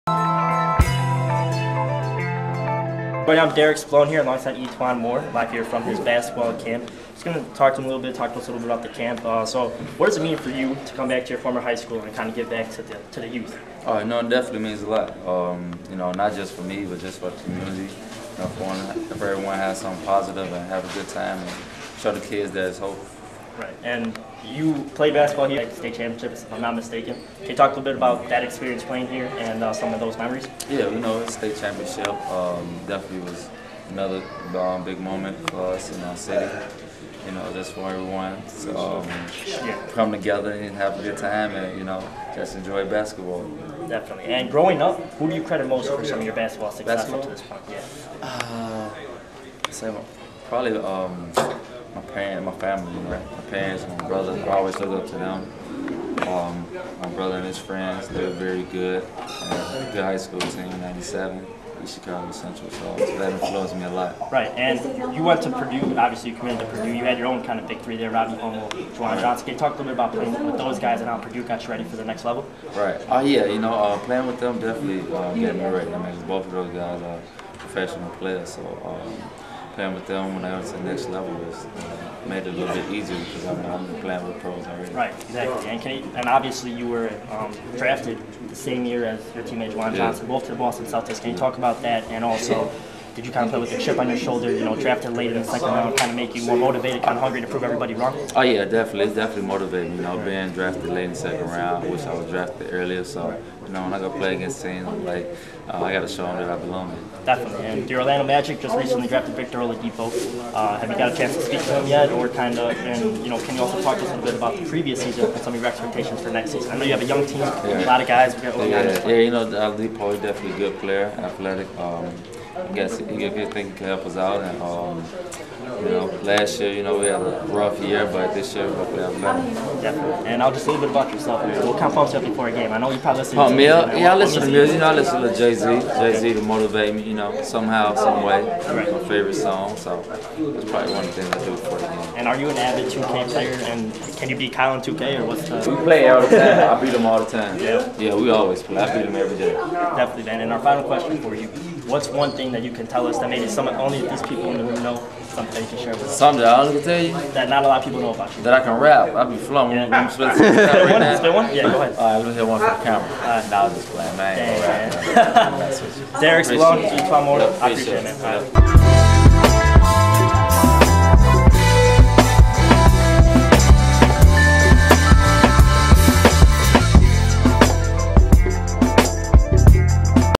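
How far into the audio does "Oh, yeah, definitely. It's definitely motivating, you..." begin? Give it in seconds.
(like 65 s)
98 s.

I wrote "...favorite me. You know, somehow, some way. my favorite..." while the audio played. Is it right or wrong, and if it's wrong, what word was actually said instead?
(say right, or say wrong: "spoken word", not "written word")
wrong: "motivate", not "favorite".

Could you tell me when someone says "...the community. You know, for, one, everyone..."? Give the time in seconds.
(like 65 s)
17 s.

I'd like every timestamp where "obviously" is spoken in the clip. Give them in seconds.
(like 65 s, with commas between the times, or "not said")
65 s, 86 s.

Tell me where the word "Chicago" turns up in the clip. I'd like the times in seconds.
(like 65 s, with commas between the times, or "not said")
61 s.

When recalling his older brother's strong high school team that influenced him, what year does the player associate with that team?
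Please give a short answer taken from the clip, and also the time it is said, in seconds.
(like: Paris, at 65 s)
97, at 60 s.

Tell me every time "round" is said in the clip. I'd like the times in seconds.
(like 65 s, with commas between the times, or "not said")
95 s, 101 s.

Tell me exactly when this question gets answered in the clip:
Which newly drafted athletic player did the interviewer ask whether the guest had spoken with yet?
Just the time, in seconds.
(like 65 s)
109 s.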